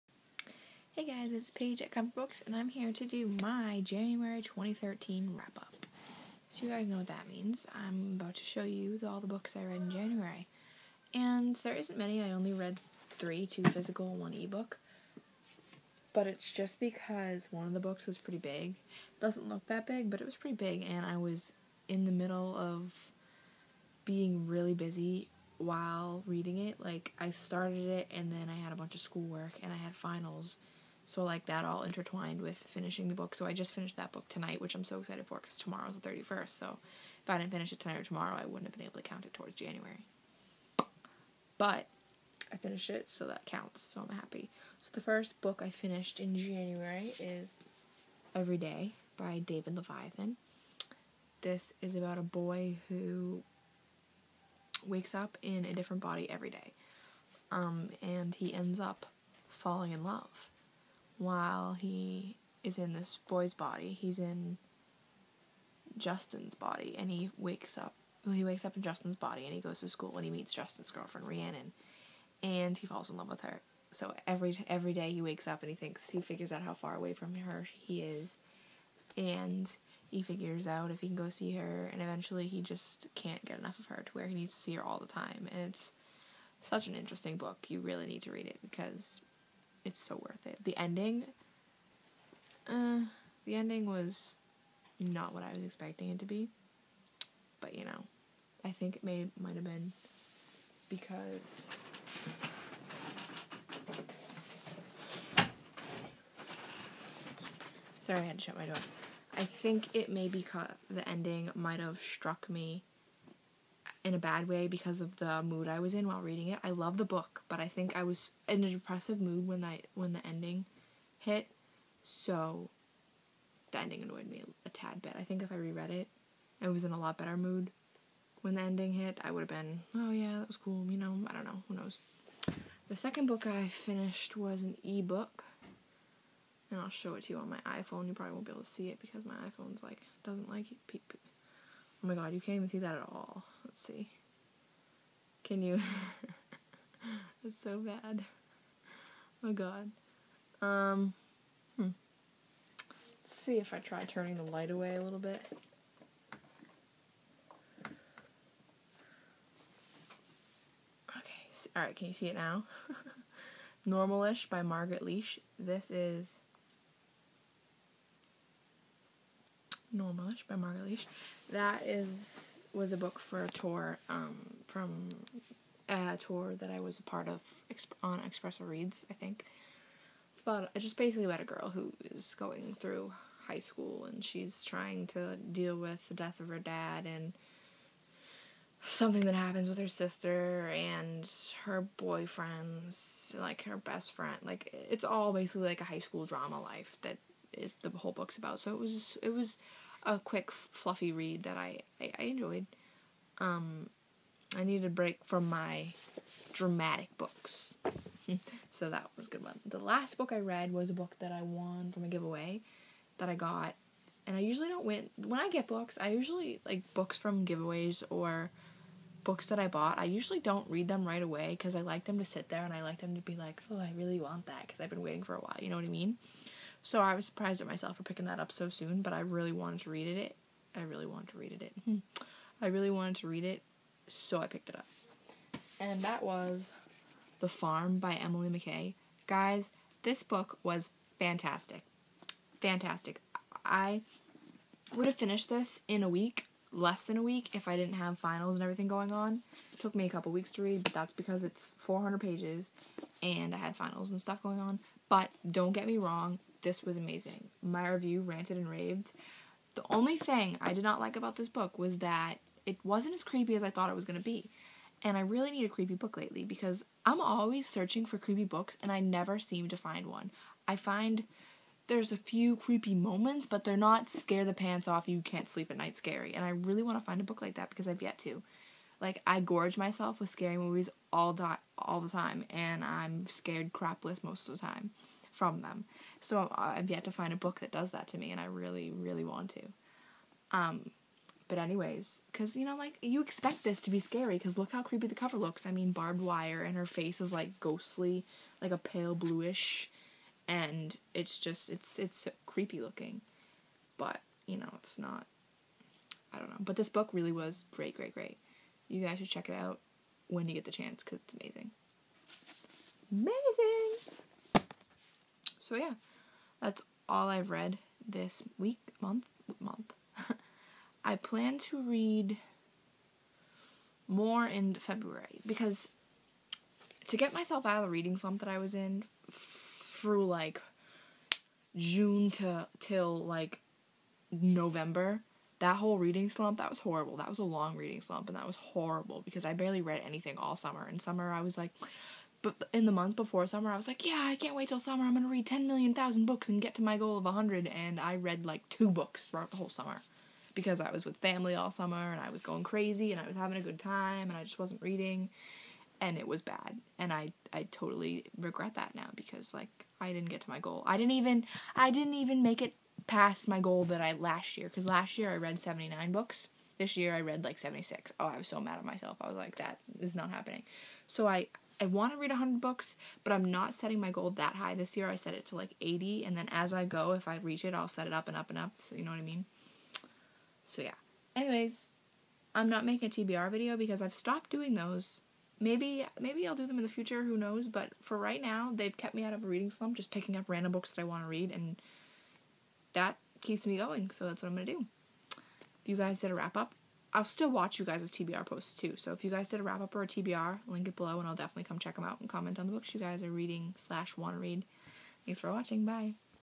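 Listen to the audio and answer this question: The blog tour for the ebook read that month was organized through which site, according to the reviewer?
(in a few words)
Xpresso Reads.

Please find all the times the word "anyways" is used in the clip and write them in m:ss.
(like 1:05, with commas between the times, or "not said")
4:51, 6:21.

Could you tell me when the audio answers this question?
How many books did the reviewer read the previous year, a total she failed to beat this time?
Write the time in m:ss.
6:05.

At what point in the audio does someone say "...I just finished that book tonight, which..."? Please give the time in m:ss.
0:33.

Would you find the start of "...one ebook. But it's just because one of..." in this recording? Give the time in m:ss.
0:14.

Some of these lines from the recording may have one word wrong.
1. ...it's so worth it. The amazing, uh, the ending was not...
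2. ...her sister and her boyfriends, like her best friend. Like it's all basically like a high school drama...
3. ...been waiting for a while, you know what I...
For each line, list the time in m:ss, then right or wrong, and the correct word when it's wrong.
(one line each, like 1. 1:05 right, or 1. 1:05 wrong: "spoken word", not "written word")
1. 1:29 wrong: "ending", not "amazing"
2. 3:09 right
3. 3:44 right.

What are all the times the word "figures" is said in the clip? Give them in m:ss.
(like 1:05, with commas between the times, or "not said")
1:16, 1:20.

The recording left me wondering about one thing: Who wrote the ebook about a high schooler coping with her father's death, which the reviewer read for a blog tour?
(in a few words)
Margaret Lesh.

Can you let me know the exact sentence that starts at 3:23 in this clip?
Um, I needed a break from my dramatic books.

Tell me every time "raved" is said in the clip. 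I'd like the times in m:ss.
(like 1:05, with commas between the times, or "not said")
4:18.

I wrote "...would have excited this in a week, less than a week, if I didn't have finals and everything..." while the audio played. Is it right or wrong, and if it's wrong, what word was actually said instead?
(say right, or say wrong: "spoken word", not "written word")
wrong: "finished", not "excited".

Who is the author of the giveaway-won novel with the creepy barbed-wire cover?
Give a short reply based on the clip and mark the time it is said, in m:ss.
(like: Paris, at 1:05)
Emily McKay, at 3:58.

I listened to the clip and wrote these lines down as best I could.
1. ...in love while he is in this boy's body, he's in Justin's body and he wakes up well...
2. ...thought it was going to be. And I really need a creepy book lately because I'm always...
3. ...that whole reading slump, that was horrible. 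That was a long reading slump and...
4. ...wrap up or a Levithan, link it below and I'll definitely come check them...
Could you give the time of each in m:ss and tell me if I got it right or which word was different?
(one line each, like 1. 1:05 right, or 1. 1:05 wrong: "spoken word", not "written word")
1. 0:59 right
2. 4:23 right
3. 5:35 right
4. 6:39 wrong: "TBR", not "Levithan".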